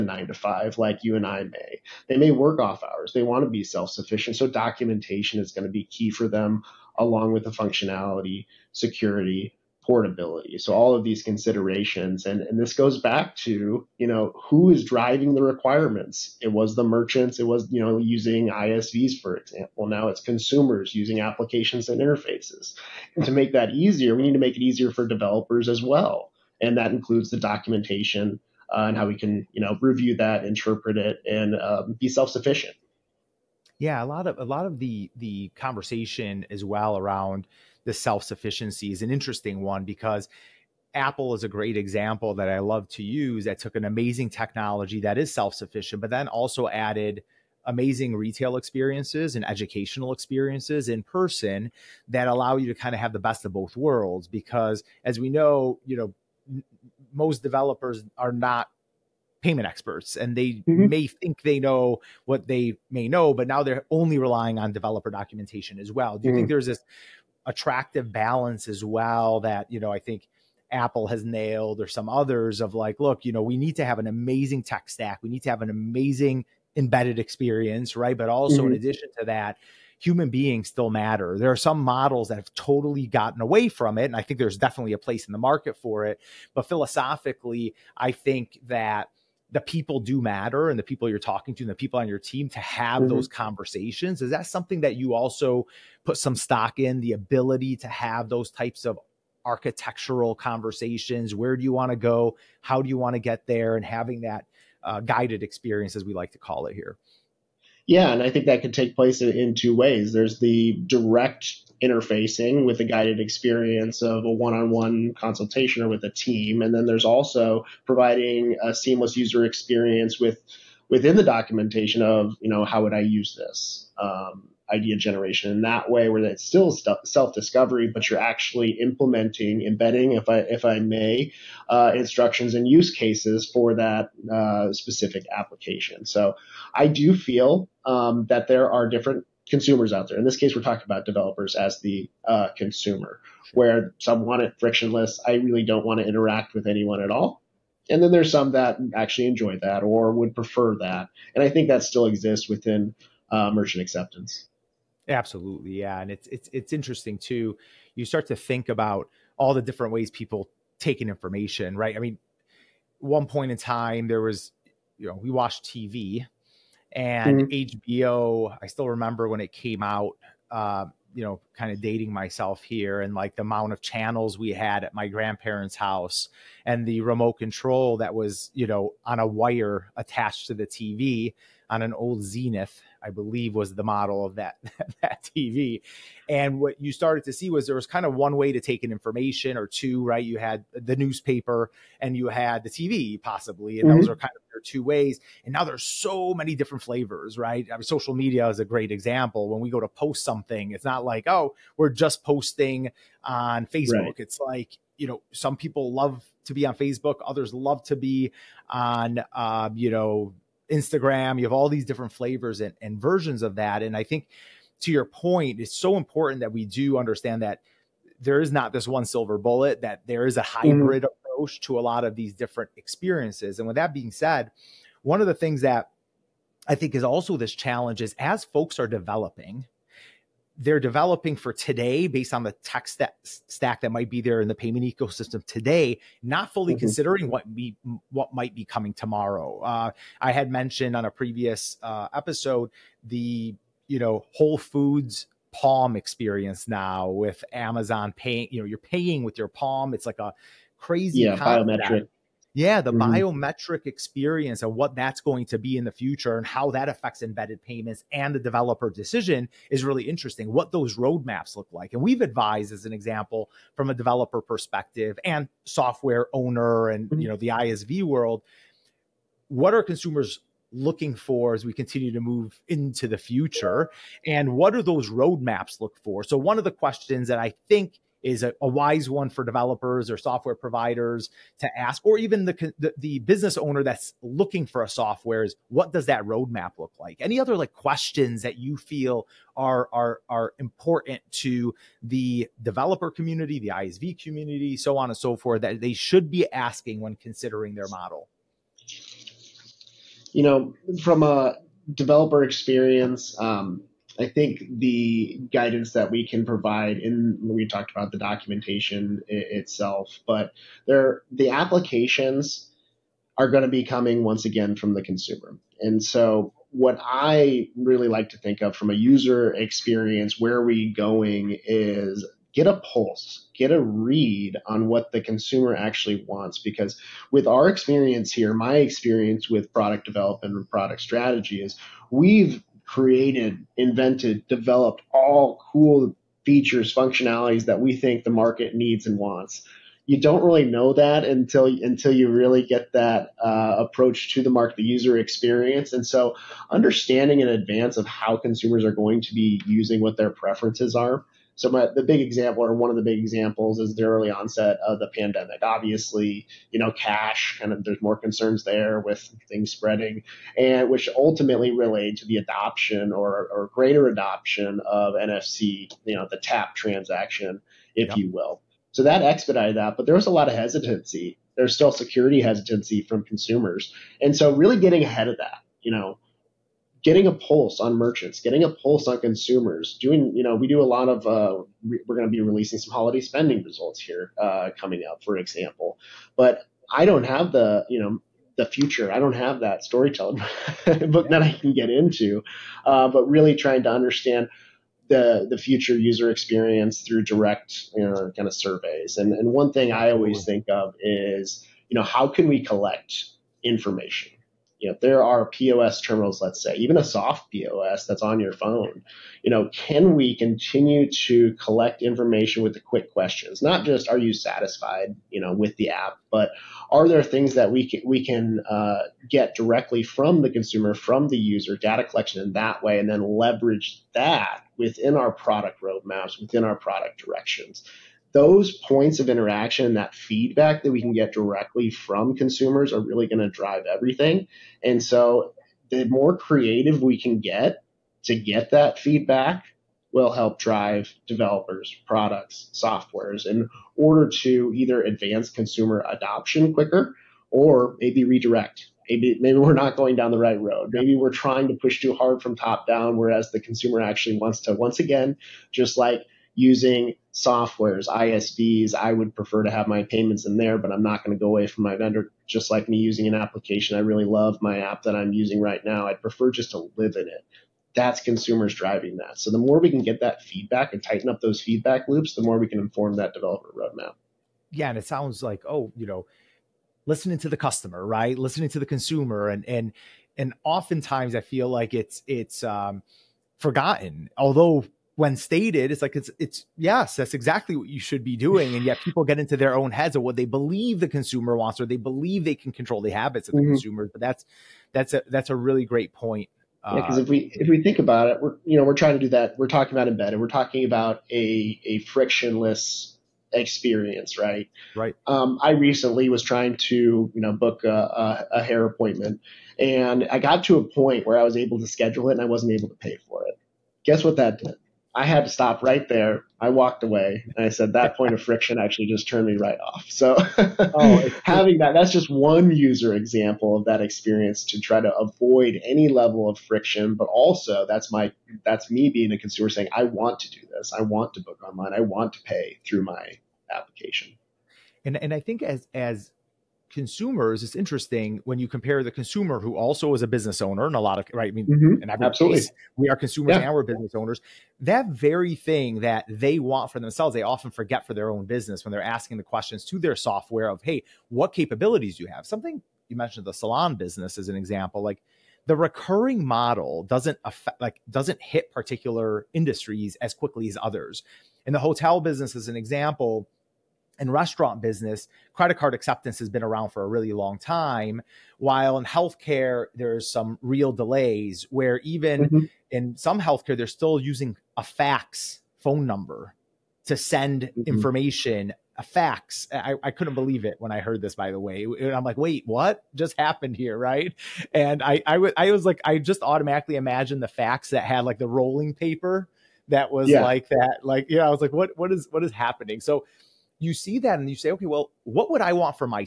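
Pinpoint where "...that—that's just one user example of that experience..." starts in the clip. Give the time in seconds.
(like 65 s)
521 s.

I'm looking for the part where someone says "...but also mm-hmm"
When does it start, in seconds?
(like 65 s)
78 s.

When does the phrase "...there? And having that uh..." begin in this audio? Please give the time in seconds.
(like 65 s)
103 s.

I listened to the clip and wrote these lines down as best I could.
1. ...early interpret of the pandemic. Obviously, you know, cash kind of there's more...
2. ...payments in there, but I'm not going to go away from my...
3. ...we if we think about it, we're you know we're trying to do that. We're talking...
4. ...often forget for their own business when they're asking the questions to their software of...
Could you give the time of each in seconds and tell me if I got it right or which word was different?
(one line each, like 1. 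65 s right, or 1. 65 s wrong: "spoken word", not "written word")
1. 354 s wrong: "onset", not "interpret"
2. 460 s right
3. 497 s right
4. 547 s right.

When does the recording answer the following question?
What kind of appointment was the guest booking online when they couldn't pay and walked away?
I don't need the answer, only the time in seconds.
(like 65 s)
508 s.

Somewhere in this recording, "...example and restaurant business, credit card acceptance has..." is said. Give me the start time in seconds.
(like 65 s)
562 s.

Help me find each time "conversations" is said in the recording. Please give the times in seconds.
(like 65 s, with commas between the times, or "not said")
35 s, 93 s, 100 s.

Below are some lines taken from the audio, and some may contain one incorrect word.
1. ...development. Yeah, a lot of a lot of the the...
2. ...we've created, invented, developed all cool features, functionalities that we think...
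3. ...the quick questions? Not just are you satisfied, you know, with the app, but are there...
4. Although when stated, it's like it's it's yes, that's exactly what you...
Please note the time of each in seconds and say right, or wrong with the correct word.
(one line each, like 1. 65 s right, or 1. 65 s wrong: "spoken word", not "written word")
1. 32 s wrong: "sufficient", not "development"
2. 332 s right
3. 412 s right
4. 484 s right.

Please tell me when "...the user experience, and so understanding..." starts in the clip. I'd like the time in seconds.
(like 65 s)
344 s.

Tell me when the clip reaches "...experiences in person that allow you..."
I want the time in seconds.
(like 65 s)
50 s.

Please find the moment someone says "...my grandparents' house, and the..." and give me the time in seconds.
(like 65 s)
174 s.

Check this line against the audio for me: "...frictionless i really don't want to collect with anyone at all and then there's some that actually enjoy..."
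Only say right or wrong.
wrong.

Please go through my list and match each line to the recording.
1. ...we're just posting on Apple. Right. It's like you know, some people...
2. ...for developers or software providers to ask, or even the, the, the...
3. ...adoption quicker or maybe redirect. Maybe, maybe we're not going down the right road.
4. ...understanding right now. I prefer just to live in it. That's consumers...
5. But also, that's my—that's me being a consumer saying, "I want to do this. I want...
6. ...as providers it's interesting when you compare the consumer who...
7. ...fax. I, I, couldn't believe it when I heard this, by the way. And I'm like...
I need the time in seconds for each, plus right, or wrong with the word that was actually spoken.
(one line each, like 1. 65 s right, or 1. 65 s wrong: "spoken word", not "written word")
1. 201 s wrong: "Facebook", not "Apple"
2. 279 s right
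3. 446 s right
4. 465 s wrong: "using", not "understanding"
5. 527 s right
6. 535 s wrong: "consumers", not "providers"
7. 579 s right.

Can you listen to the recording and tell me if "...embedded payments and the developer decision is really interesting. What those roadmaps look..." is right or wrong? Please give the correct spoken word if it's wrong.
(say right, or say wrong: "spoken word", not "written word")
right.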